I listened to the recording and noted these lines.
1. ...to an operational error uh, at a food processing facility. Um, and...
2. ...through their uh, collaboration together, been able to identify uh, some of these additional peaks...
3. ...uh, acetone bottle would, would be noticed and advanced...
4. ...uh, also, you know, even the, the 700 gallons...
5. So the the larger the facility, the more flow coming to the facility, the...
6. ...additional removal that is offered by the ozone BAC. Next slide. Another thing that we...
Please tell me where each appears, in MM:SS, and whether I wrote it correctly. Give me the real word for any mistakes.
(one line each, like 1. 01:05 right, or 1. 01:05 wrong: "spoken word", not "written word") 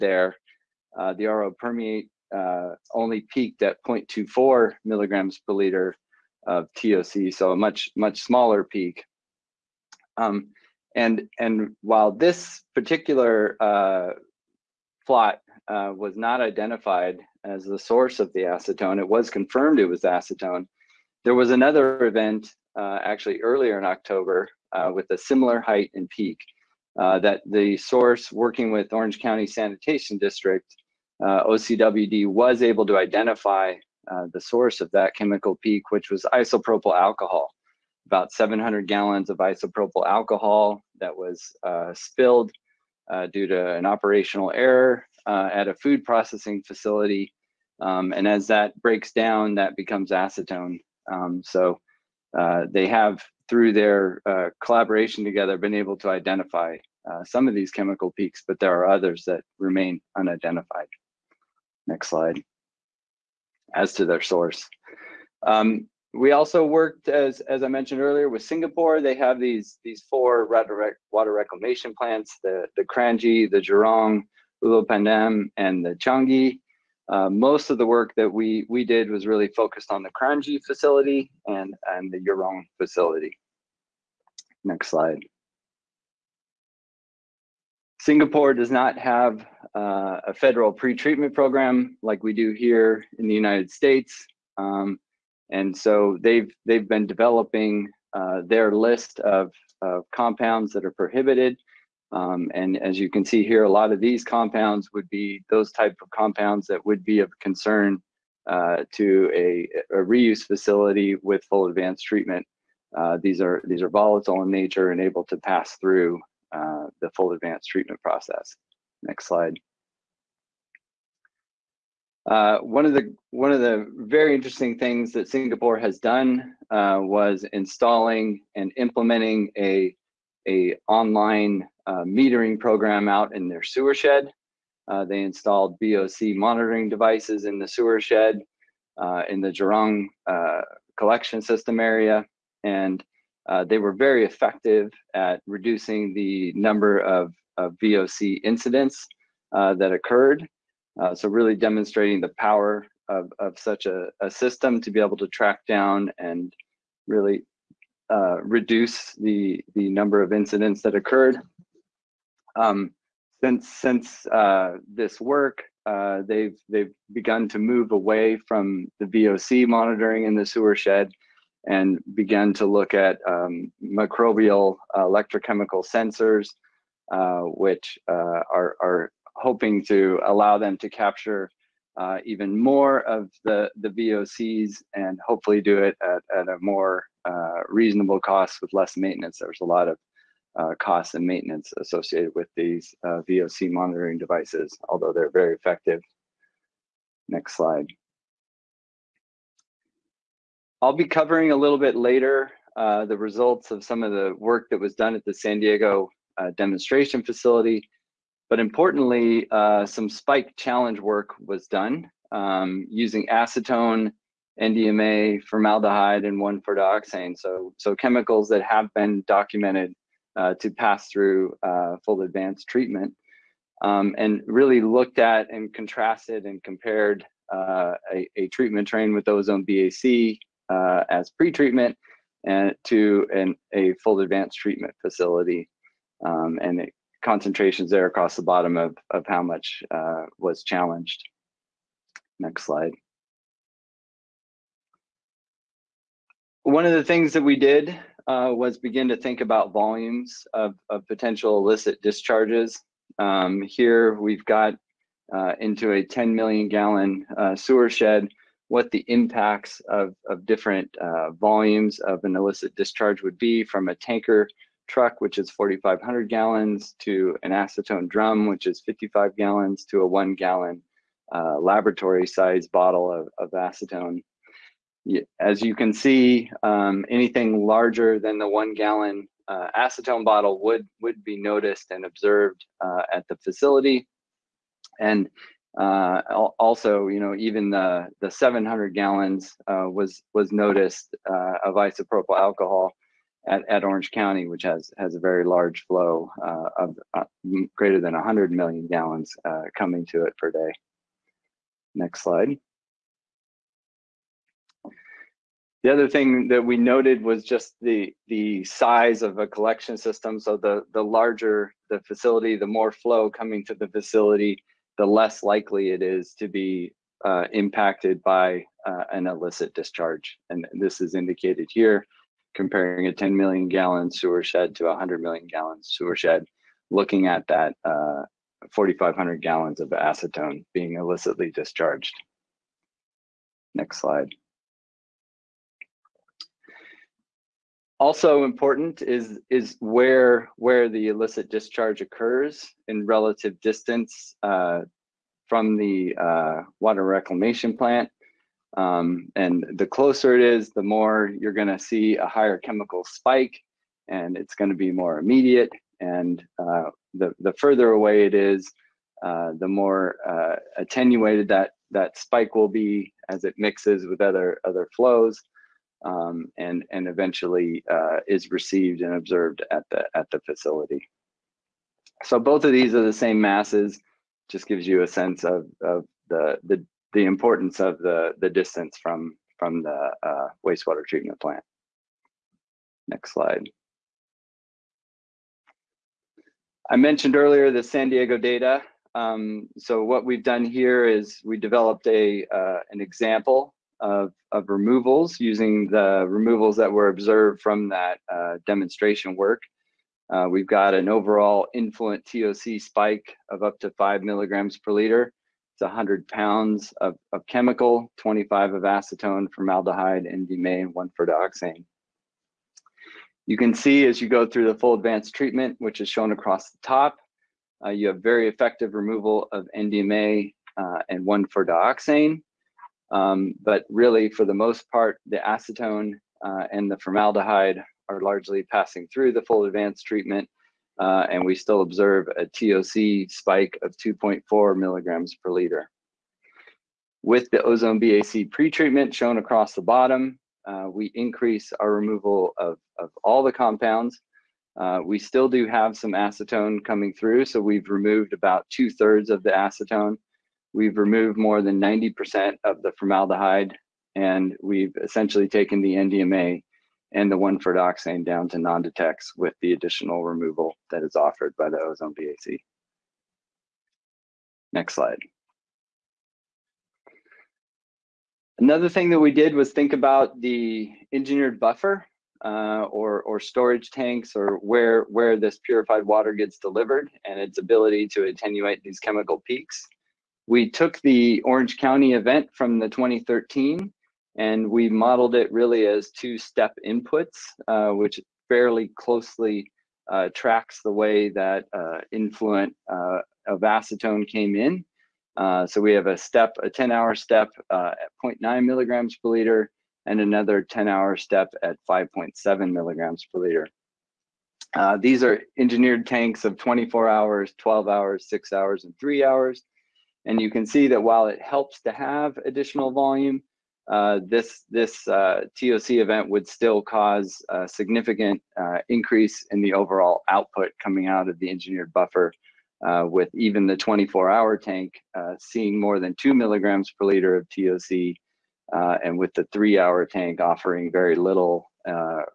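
1. 00:43 right
2. 00:53 wrong: "chemical", not "additional"
3. 04:39 wrong: "observed", not "advanced"
4. 04:45 right
5. 05:10 right
6. 07:39 right.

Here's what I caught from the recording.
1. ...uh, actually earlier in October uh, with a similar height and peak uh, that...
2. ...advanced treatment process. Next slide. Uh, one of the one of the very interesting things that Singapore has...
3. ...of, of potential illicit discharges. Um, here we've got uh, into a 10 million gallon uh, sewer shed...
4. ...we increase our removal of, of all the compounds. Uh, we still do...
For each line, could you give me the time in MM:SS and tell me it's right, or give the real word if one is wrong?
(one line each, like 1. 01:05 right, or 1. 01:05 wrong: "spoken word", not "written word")
1. 00:22 right
2. 01:57 right
3. 04:10 right
4. 07:20 right.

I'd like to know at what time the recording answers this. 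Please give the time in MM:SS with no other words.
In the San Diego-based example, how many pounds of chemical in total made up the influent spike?
06:45.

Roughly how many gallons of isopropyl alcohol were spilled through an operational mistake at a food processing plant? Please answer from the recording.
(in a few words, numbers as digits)
700 gallons.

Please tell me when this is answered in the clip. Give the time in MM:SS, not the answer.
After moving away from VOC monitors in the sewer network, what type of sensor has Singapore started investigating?
02:53.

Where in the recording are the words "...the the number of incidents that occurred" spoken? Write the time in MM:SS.
02:39.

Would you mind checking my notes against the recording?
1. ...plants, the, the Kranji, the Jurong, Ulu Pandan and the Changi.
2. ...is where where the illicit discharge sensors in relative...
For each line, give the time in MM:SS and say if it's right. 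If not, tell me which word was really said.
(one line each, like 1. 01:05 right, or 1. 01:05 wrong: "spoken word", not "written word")
1. 01:11 right
2. 05:39 wrong: "occurs", not "sensors".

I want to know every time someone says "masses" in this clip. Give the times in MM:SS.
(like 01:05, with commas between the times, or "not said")
06:13.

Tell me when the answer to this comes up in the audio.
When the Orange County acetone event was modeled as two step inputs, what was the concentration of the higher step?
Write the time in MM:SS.
08:21.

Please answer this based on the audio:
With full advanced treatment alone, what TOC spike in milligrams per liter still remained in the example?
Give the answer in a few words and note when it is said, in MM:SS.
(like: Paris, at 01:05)
2.4 mg/L, at 07:13.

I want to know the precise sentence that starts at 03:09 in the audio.
There's a lot of uh, costs and maintenance associated with these uh, VOC monitoring devices, although they're very effective.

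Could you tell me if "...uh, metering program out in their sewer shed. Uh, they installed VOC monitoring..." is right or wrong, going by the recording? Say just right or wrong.
right.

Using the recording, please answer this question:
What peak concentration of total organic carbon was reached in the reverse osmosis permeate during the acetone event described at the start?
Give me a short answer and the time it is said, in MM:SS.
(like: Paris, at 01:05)
0.24 mg/L, at 00:03.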